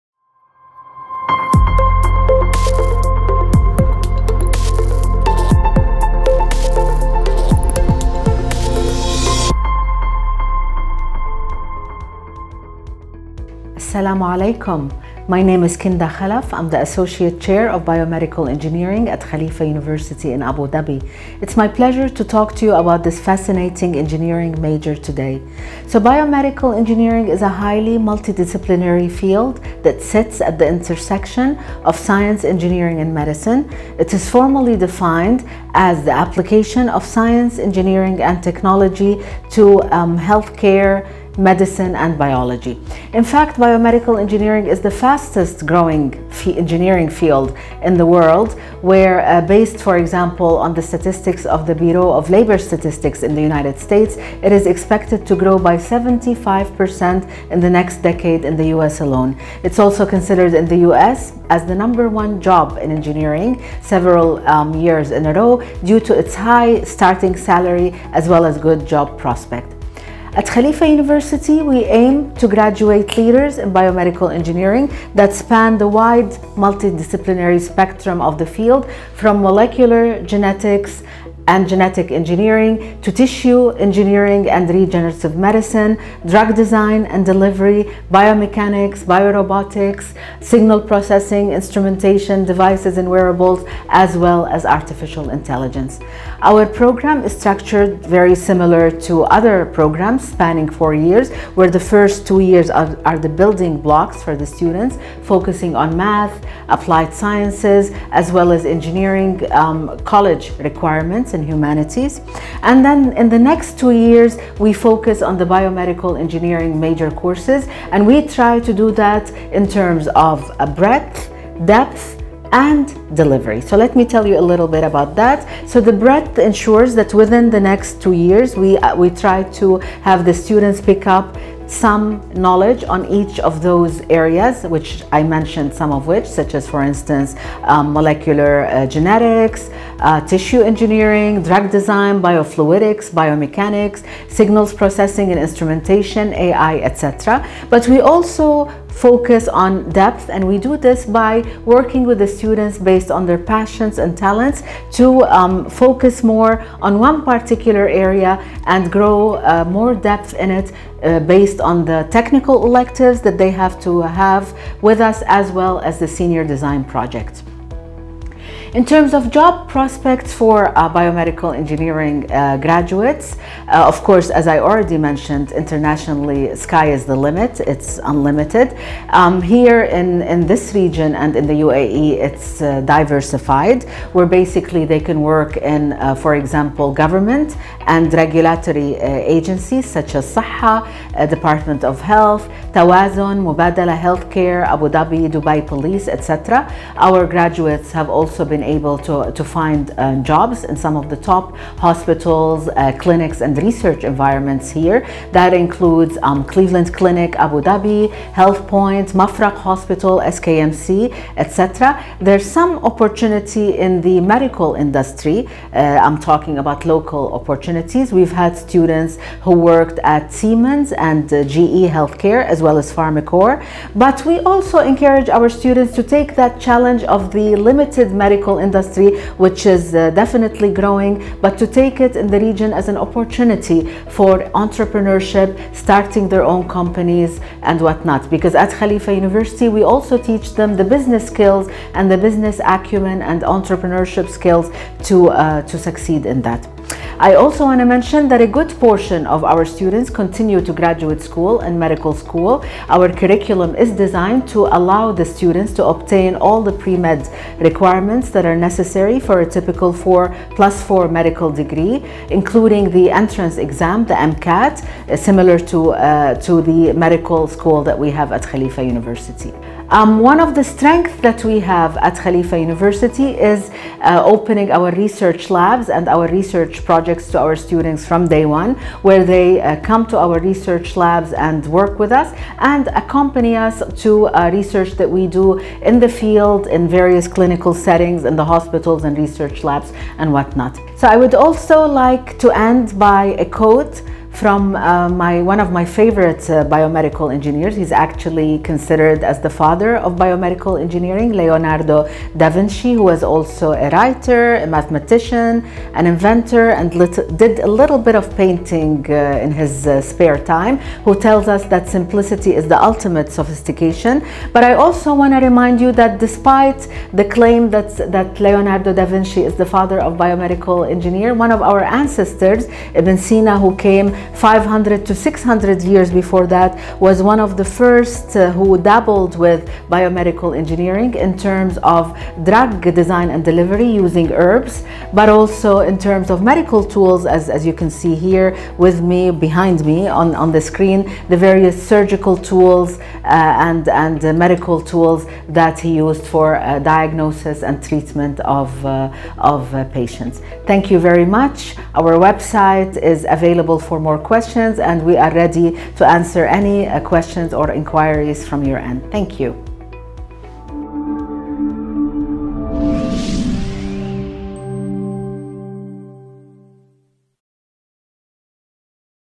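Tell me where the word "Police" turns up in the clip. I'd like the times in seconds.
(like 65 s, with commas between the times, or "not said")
195 s.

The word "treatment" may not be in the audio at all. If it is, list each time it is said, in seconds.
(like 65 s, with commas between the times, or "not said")
347 s.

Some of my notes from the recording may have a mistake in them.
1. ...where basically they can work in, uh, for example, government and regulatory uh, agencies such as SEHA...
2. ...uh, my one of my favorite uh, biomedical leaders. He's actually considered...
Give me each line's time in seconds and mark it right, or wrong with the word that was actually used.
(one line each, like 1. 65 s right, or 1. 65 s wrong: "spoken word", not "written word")
1. 184 s right
2. 294 s wrong: "engineers", not "leaders".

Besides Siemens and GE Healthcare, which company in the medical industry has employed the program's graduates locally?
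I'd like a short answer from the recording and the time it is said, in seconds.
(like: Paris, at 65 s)
Pharmacore, at 222 s.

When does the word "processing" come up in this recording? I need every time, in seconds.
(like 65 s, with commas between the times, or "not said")
90 s, 144 s.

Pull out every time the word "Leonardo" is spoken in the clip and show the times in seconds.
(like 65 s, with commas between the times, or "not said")
301 s, 318 s.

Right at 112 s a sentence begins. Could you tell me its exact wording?
And then in the next two years, we focus on the biomedical engineering major courses.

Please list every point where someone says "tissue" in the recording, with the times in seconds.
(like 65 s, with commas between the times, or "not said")
83 s, 140 s.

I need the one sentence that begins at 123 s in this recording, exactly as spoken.
So let me tell you a little bit about that.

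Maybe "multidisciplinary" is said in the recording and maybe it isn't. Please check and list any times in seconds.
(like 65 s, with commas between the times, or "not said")
27 s, 76 s.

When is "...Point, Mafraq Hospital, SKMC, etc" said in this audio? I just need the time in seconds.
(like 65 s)
208 s.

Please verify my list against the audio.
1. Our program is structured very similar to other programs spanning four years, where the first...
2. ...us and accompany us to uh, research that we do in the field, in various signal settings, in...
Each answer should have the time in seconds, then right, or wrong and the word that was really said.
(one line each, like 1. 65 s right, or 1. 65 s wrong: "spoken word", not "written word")
1. 96 s right
2. 282 s wrong: "clinical", not "signal".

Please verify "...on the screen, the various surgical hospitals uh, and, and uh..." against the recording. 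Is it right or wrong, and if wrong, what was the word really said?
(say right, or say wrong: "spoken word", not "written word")
wrong: "tools", not "hospitals".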